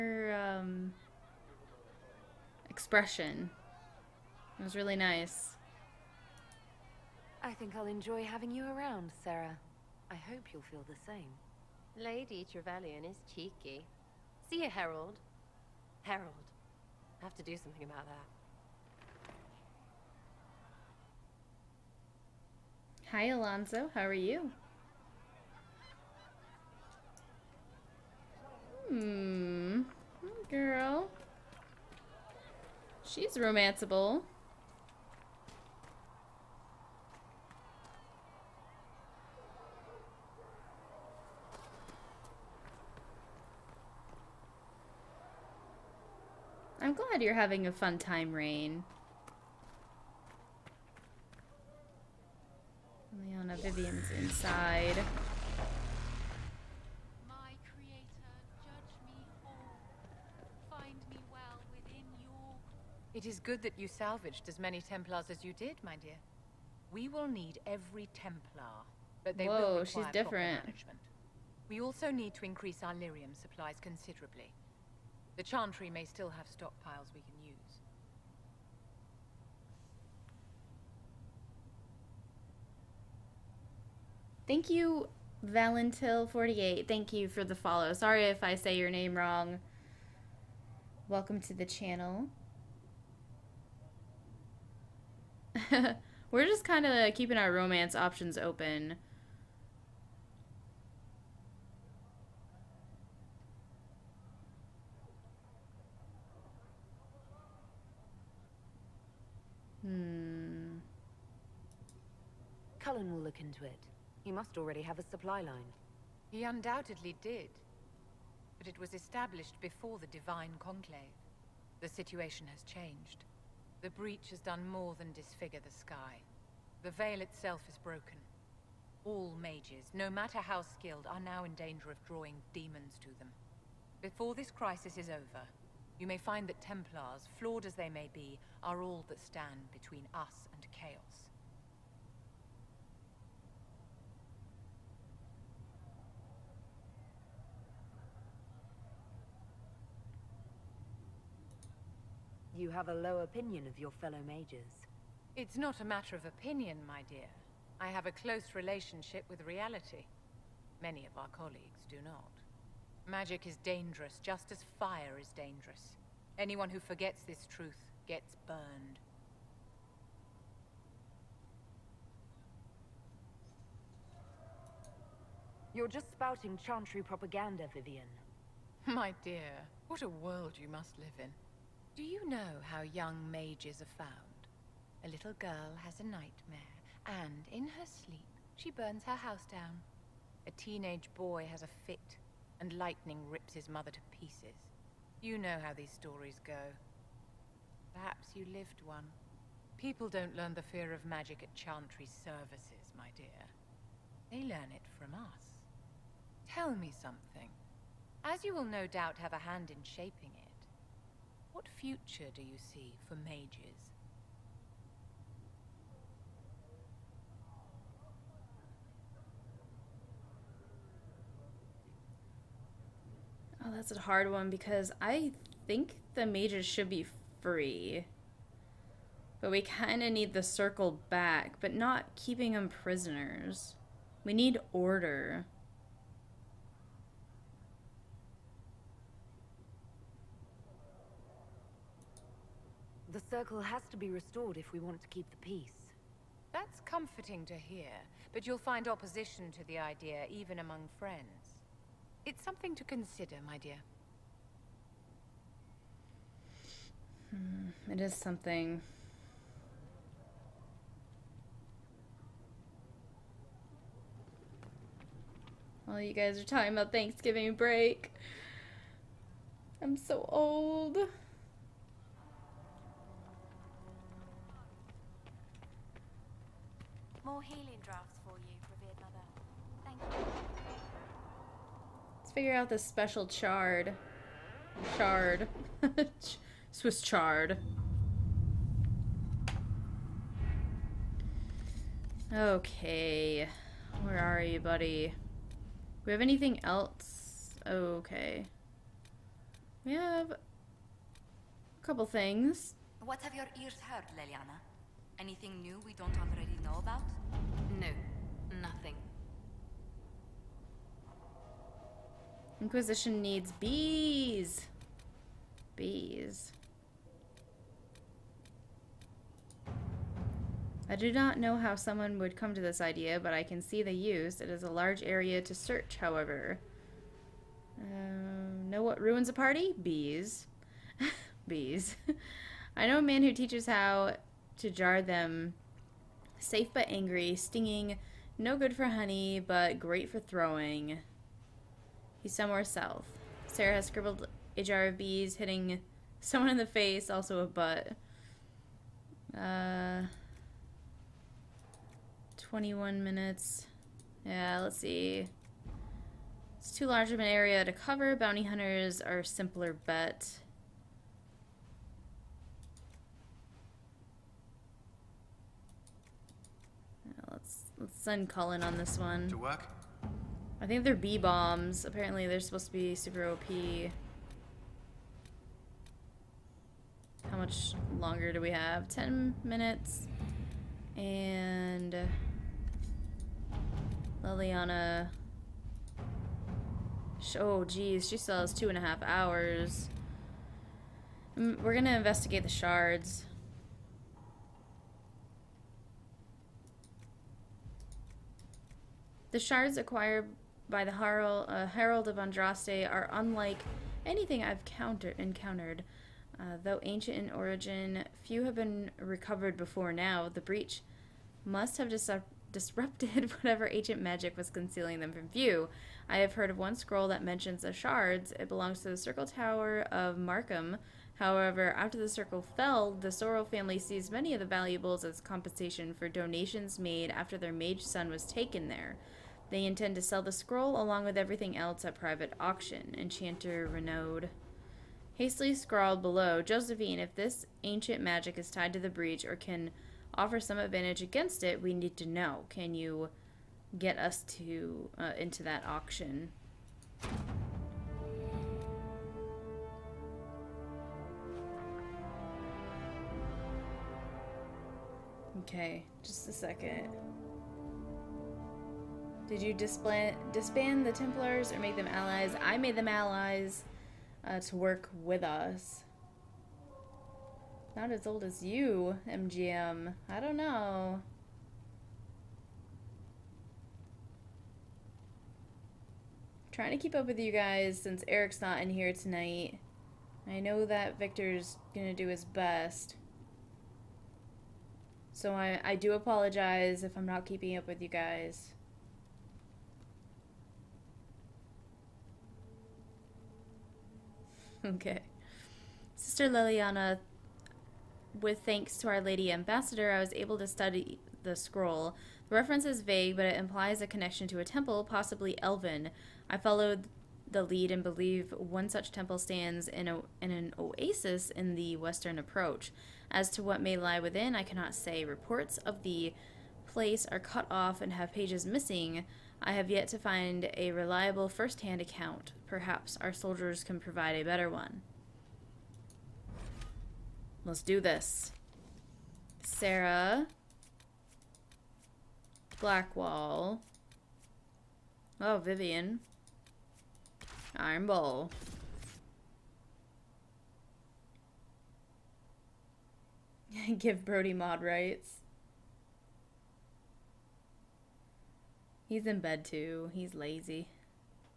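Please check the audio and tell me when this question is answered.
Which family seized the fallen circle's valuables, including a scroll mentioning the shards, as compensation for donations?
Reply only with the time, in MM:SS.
07:03.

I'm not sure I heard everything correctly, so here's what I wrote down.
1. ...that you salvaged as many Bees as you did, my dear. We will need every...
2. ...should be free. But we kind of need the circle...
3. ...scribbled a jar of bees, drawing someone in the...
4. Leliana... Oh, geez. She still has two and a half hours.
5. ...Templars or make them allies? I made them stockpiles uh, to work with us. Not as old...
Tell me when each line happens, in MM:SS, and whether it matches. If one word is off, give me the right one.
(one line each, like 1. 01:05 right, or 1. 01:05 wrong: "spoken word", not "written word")
1. 01:03 wrong: "Templars", not "Bees"
2. 03:46 right
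3. 05:43 wrong: "hitting", not "drawing"
4. 06:24 right
5. 07:40 wrong: "allies", not "stockpiles".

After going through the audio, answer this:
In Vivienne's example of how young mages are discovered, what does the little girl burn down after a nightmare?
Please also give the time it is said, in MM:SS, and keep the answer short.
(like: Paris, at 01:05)
Her house, at 03:09.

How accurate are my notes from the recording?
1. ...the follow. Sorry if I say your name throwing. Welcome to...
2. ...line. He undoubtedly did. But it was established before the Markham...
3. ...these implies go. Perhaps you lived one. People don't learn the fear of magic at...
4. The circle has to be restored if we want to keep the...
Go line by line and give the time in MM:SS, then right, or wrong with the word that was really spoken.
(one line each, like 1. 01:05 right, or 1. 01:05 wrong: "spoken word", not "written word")
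1. 01:27 wrong: "wrong", not "throwing"
2. 01:55 wrong: "Divine", not "Markham"
3. 03:15 wrong: "stories", not "implies"
4. 04:03 right.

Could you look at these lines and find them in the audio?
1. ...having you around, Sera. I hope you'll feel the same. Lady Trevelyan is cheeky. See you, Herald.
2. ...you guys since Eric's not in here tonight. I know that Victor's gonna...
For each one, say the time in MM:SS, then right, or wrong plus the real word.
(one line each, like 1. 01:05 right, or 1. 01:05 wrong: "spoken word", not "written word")
1. 00:08 right
2. 07:57 right.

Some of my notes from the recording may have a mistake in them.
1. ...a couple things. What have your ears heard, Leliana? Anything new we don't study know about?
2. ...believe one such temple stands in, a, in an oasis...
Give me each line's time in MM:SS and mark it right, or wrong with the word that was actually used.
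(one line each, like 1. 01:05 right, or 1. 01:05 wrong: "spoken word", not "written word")
1. 05:00 wrong: "already", not "study"
2. 08:27 right.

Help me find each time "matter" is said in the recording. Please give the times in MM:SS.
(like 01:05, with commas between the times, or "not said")
02:10, 02:35.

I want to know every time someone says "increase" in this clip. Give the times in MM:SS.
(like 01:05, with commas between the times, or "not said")
01:12.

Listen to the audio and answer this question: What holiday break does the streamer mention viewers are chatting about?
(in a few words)
Thanksgiving.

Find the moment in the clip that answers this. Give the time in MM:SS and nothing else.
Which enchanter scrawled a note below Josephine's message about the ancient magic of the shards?
07:13.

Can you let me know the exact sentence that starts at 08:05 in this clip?
So I, I do apologize if I'm not keeping up with you guys.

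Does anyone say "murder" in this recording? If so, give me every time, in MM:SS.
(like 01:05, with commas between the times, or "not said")
not said.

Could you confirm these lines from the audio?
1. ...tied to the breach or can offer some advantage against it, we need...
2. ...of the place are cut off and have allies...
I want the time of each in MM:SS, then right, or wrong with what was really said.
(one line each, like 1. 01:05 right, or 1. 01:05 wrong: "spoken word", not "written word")
1. 07:18 right
2. 08:35 wrong: "pages", not "allies".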